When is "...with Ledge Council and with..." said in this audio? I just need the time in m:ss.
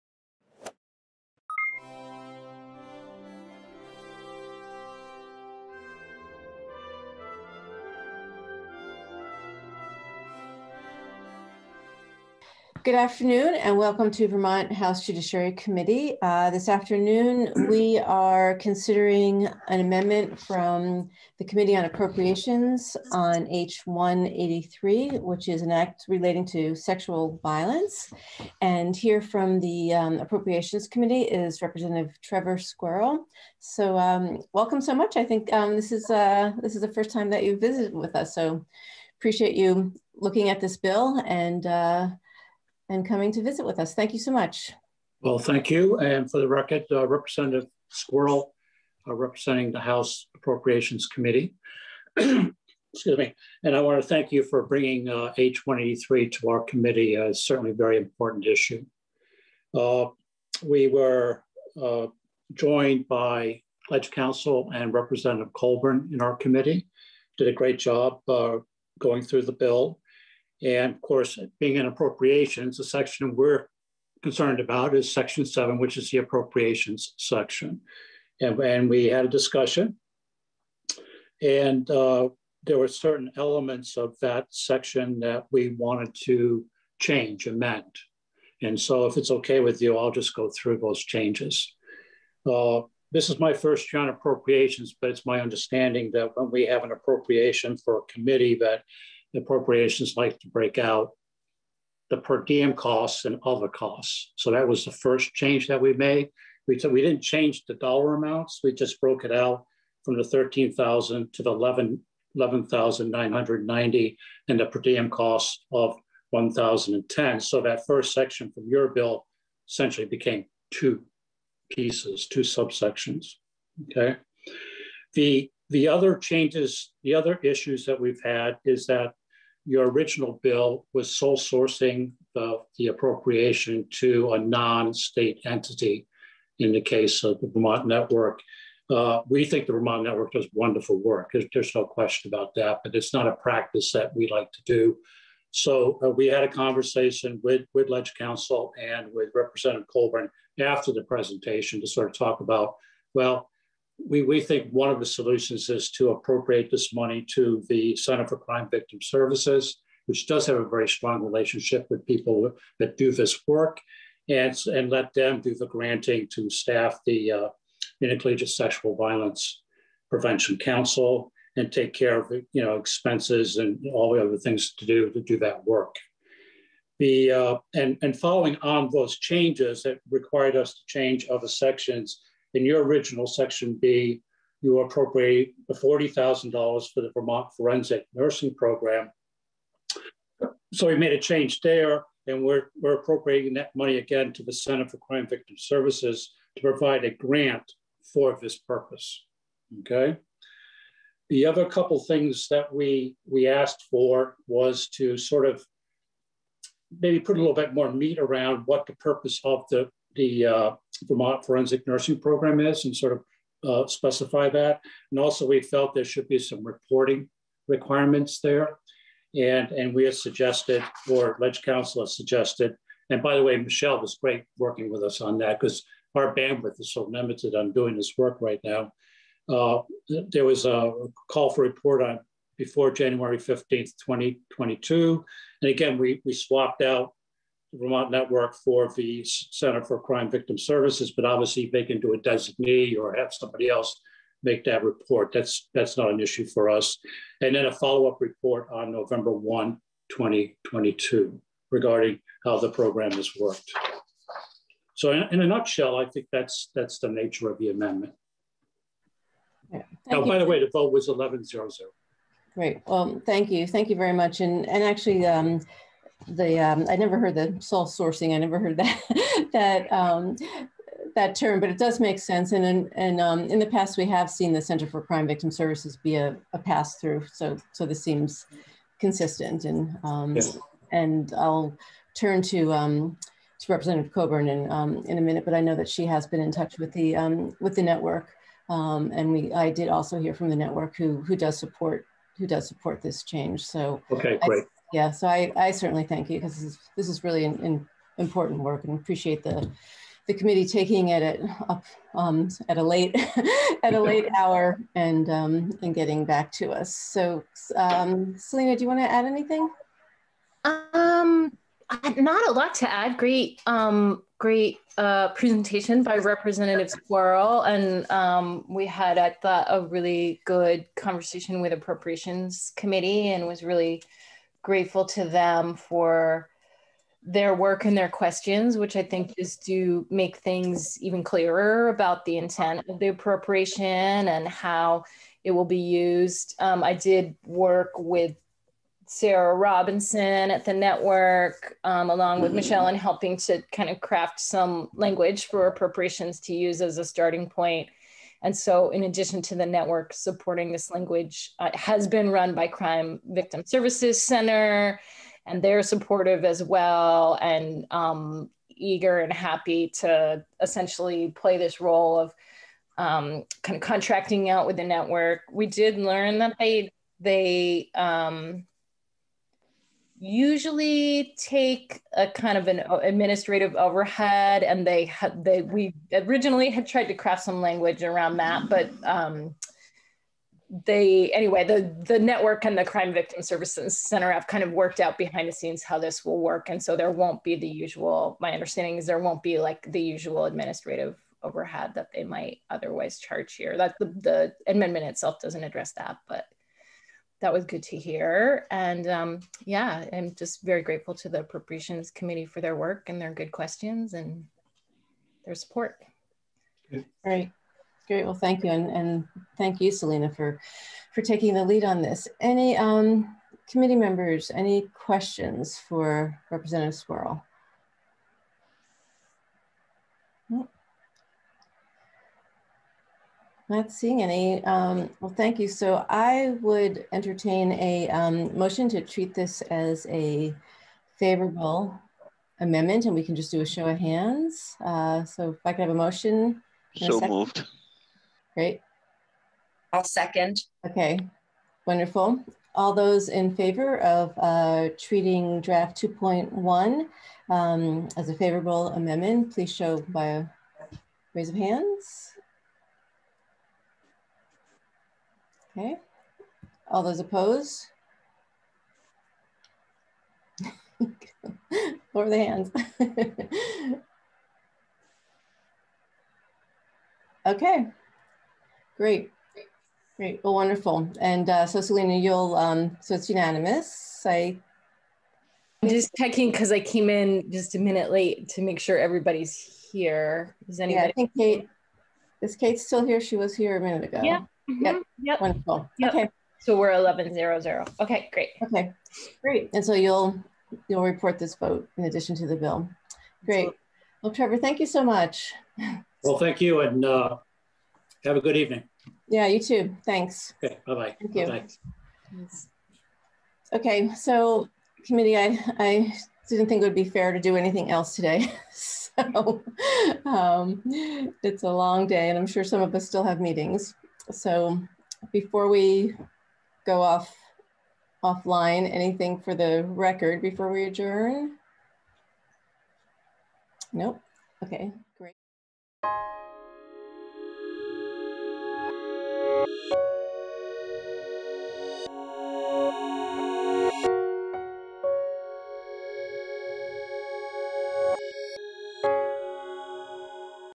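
2:27.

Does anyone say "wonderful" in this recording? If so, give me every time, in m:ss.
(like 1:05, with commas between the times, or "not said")
2:20, 7:21, 7:50, 8:05.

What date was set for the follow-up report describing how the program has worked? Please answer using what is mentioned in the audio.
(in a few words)
November 1, 2022.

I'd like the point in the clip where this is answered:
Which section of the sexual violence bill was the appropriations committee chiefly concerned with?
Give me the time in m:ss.
1:15.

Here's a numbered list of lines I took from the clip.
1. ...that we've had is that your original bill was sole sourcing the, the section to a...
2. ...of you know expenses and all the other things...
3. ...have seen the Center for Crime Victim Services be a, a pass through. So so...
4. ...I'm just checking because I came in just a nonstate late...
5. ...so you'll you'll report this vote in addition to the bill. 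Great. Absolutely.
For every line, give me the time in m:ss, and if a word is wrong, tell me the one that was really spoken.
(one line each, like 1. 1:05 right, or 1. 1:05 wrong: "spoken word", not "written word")
1. 2:07 wrong: "appropriation", not "section"
2. 2:52 right
3. 4:34 right
4. 7:55 wrong: "minute", not "nonstate"
5. 8:09 right.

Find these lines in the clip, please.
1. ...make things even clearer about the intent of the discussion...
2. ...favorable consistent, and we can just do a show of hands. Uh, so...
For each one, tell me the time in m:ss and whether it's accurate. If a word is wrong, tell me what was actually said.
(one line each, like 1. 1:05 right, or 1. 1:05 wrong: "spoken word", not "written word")
1. 5:30 wrong: "appropriation", not "discussion"
2. 7:11 wrong: "amendment", not "consistent".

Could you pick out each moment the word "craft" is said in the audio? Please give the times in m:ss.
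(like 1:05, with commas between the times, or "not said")
5:43, 6:17.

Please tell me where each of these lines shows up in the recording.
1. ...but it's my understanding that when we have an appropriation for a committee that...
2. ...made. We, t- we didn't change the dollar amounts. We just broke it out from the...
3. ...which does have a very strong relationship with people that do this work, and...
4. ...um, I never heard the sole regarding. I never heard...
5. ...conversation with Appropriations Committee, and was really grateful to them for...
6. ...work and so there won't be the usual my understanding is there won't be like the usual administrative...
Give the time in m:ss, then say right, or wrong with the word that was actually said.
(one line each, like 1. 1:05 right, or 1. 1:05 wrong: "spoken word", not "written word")
1. 1:35 right
2. 1:45 right
3. 2:40 right
4. 4:26 wrong: "sourcing", not "regarding"
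5. 5:20 right
6. 6:26 right.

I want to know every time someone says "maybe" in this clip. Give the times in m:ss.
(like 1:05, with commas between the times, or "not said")
3:27.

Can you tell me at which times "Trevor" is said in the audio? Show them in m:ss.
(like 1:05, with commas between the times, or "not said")
0:32, 8:14.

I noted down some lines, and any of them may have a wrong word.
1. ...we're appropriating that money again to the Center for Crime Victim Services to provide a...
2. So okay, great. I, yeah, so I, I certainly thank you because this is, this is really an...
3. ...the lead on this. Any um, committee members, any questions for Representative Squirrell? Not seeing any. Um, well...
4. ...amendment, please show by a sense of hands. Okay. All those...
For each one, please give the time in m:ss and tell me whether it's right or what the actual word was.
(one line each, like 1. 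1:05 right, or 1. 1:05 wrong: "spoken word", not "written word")
1. 3:12 right
2. 4:53 right
3. 6:51 right
4. 7:28 wrong: "raise", not "sense".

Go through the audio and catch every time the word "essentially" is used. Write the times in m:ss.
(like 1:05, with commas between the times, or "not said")
1:59, 6:00.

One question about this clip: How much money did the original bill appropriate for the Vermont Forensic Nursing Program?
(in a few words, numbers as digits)
$40,000.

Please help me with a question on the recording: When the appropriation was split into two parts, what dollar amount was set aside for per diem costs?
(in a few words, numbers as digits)
$1,010.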